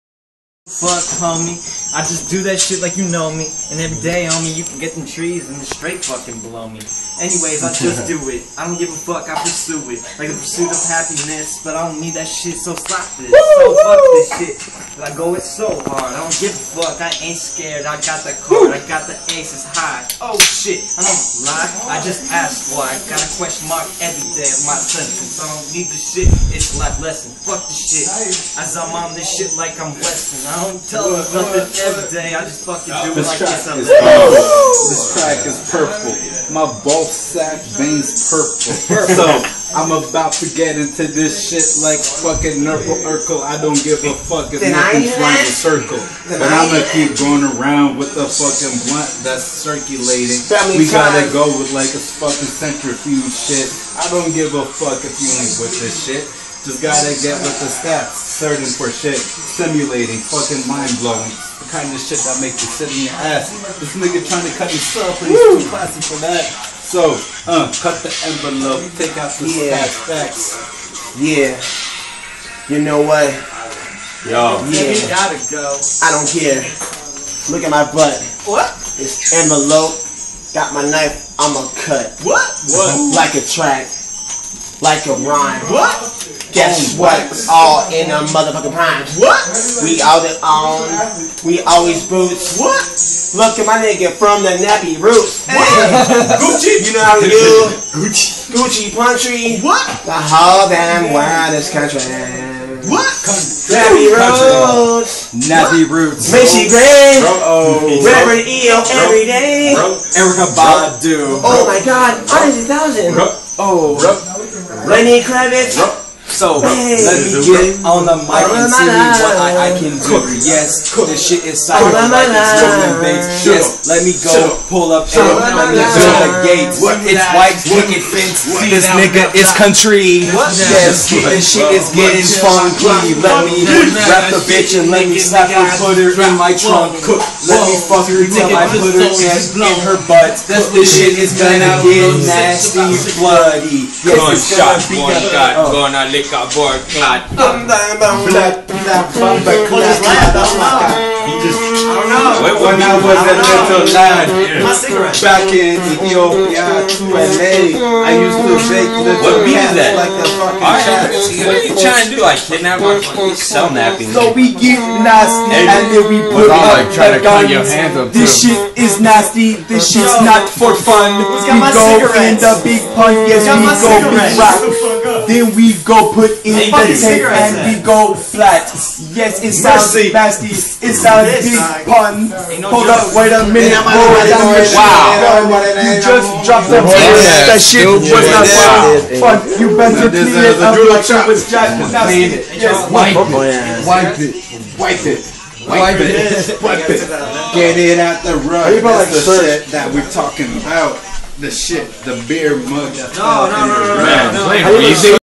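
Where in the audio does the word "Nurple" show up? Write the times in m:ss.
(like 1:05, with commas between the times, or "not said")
0:42.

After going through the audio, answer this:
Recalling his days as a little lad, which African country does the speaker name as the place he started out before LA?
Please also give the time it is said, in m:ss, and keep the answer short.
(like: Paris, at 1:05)
Ethiopia, at 2:35.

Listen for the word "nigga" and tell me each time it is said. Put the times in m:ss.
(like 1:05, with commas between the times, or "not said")
1:03, 1:33, 2:08.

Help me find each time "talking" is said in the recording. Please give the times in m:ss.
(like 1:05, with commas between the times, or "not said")
3:20.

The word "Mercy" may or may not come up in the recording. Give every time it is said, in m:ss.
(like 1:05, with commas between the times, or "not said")
2:59.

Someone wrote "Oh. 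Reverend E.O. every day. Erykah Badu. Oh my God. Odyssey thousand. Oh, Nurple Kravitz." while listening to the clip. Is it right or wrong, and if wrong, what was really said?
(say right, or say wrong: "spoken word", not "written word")
wrong: "Lenny", not "Nurple".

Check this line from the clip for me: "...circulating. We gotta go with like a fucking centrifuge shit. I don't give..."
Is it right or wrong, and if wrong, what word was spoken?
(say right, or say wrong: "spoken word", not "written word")
right.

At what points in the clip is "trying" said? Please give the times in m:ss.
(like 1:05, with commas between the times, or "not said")
1:04, 2:41.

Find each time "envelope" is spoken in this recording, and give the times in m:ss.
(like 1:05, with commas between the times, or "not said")
1:08, 1:19.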